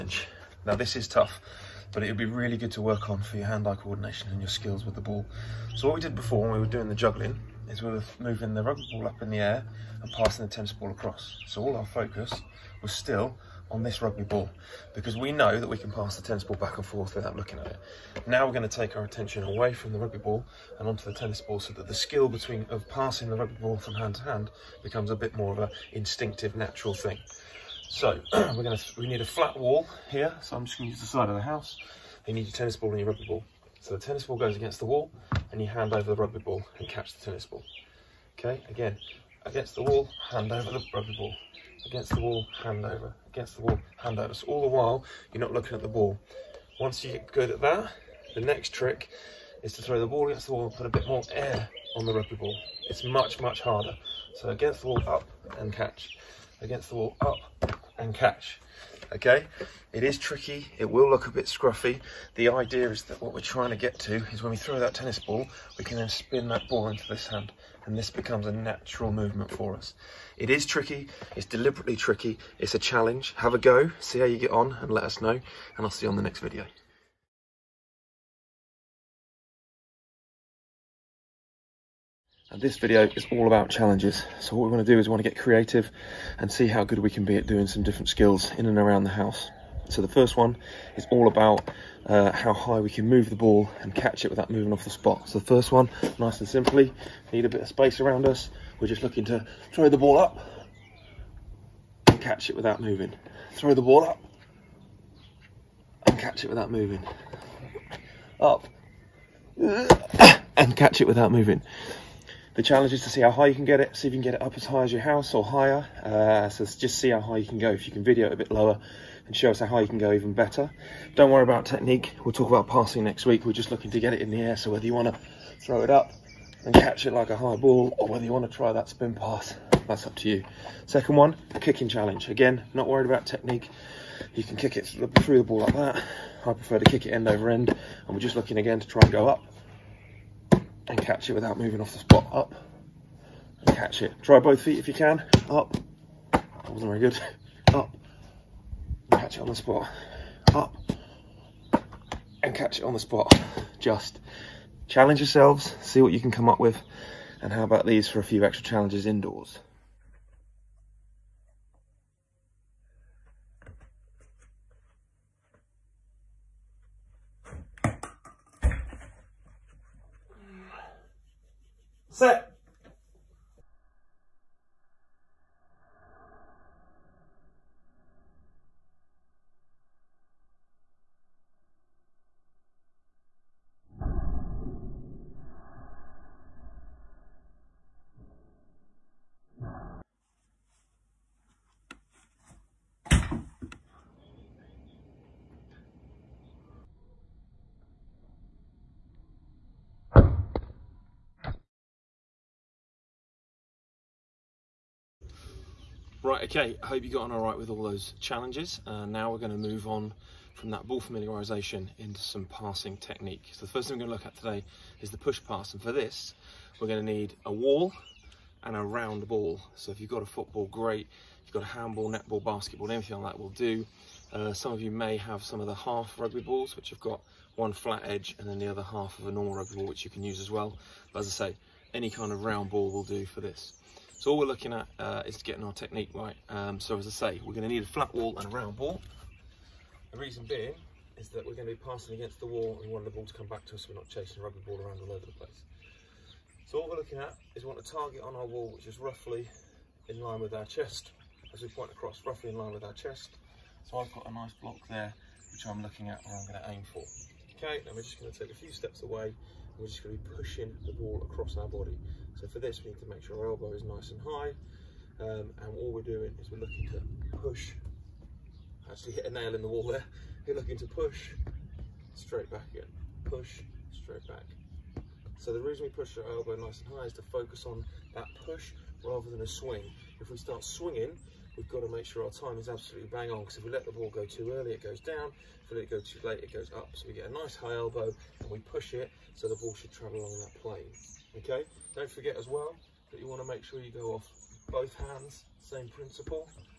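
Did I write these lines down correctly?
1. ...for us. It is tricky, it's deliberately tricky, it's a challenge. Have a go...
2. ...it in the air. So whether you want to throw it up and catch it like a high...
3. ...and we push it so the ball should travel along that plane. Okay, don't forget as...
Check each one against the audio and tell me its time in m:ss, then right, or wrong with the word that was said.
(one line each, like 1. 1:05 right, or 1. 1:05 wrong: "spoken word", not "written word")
1. 1:09 right
2. 2:04 right
3. 4:48 right.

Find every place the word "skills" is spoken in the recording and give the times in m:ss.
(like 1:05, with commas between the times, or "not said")
0:04, 0:21, 1:28.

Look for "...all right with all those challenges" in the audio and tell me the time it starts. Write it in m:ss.
3:27.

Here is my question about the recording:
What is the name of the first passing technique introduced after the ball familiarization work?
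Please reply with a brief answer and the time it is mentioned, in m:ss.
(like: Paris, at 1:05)
Push pass, at 3:35.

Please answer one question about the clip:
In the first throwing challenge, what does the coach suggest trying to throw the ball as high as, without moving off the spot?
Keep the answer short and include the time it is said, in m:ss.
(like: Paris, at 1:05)
Your house, at 1:54.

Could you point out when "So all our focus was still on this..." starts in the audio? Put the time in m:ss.
0:11.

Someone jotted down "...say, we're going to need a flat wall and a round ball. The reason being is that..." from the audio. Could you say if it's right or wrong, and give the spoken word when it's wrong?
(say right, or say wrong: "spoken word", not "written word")
right.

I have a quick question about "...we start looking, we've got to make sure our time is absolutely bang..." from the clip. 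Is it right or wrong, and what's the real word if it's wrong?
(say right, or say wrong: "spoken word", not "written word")
wrong: "swinging", not "looking".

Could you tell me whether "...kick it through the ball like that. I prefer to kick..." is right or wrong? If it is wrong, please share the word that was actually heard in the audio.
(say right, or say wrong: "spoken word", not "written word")
right.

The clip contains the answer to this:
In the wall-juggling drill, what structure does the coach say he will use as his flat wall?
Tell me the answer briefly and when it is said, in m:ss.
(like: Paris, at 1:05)
The side of the house, at 0:31.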